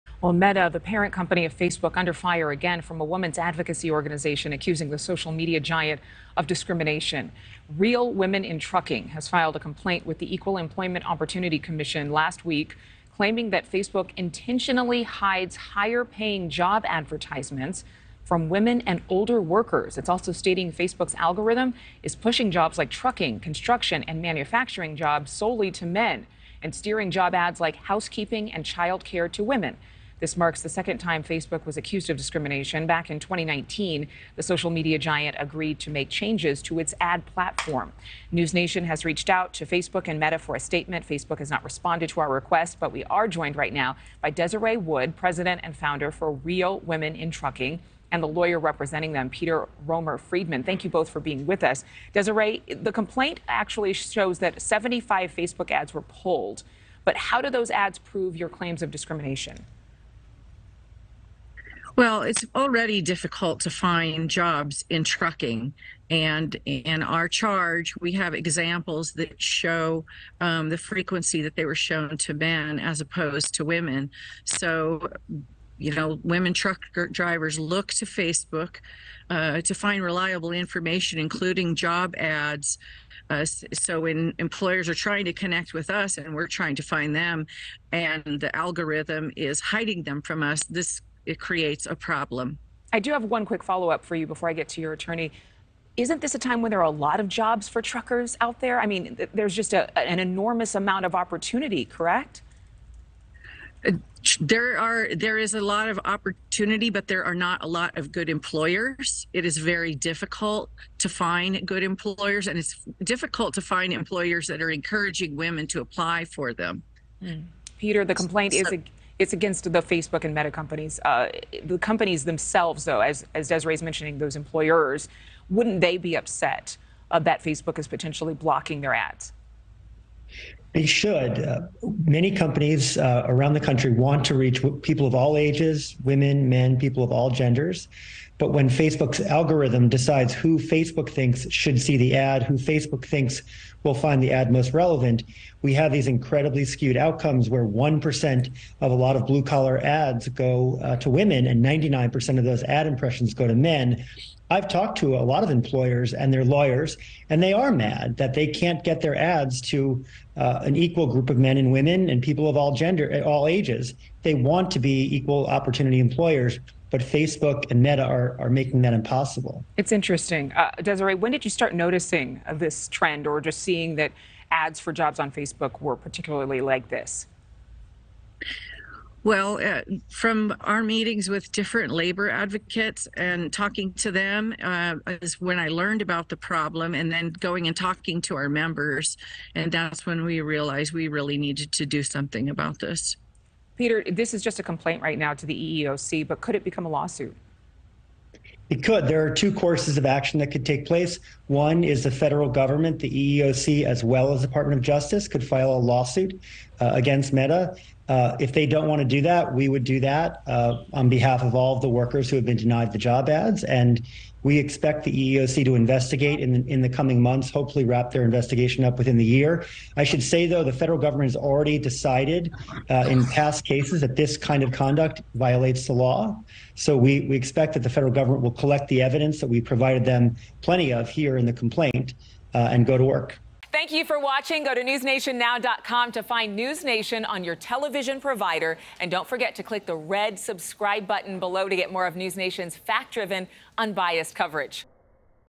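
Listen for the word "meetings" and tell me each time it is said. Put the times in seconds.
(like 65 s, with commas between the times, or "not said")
180 s.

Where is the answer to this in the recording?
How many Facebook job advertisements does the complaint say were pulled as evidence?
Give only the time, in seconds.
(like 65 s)
54 s.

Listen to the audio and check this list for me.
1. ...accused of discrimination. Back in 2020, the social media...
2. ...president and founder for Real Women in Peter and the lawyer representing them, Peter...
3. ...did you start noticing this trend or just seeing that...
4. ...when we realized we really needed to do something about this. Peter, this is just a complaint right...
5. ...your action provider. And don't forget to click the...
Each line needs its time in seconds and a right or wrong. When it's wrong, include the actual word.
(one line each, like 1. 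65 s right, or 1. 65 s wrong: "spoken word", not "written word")
1. 31 s wrong: "2019", not "2020"
2. 45 s wrong: "Trucking", not "Peter"
3. 171 s right
4. 190 s right
5. 237 s wrong: "television", not "action".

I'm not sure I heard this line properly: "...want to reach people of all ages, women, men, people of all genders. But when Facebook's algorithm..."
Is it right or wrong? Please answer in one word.
right.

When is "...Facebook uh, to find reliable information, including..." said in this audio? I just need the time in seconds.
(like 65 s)
78 s.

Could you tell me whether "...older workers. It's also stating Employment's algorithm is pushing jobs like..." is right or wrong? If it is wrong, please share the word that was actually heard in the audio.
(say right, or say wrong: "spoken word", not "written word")
wrong: "Facebook", not "Employment".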